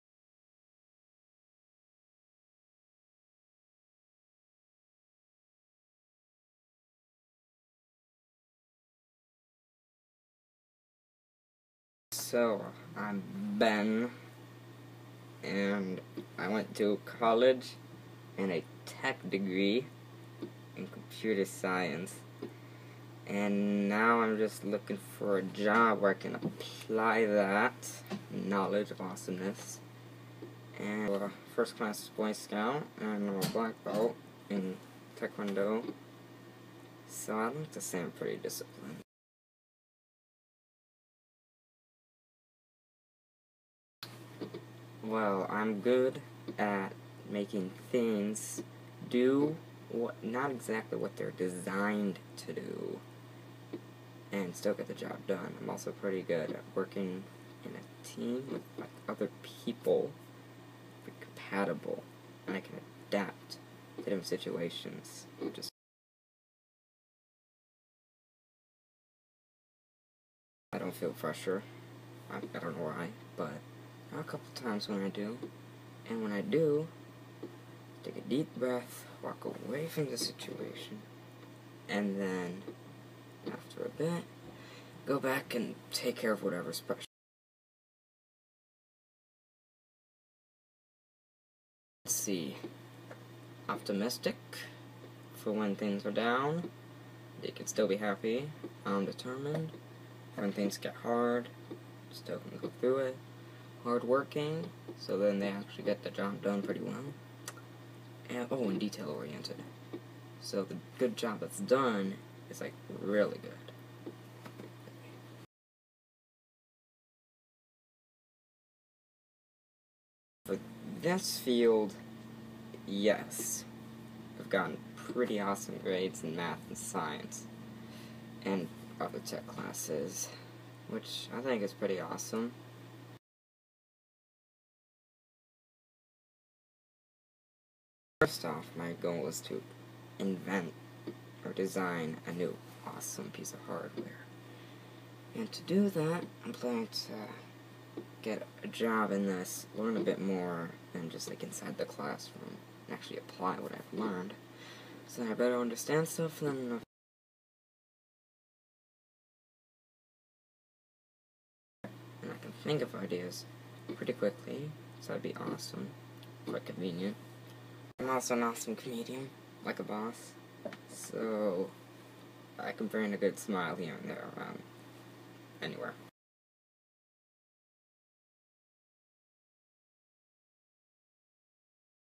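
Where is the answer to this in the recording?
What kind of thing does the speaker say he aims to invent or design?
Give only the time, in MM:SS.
02:23.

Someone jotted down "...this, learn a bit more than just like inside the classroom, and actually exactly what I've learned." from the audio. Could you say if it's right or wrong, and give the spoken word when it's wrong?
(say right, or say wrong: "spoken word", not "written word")
wrong: "apply", not "exactly".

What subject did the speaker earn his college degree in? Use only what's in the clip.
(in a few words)
Computer science.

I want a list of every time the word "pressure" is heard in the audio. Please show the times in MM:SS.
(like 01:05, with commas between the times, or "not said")
01:11.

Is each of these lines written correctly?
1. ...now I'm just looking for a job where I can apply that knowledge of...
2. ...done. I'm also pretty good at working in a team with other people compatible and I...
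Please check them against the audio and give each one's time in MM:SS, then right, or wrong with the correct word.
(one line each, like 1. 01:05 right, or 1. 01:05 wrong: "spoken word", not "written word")
1. 00:23 right
2. 00:55 right.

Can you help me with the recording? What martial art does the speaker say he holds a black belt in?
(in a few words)
Taekwondo.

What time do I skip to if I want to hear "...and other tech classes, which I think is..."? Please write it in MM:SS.
02:08.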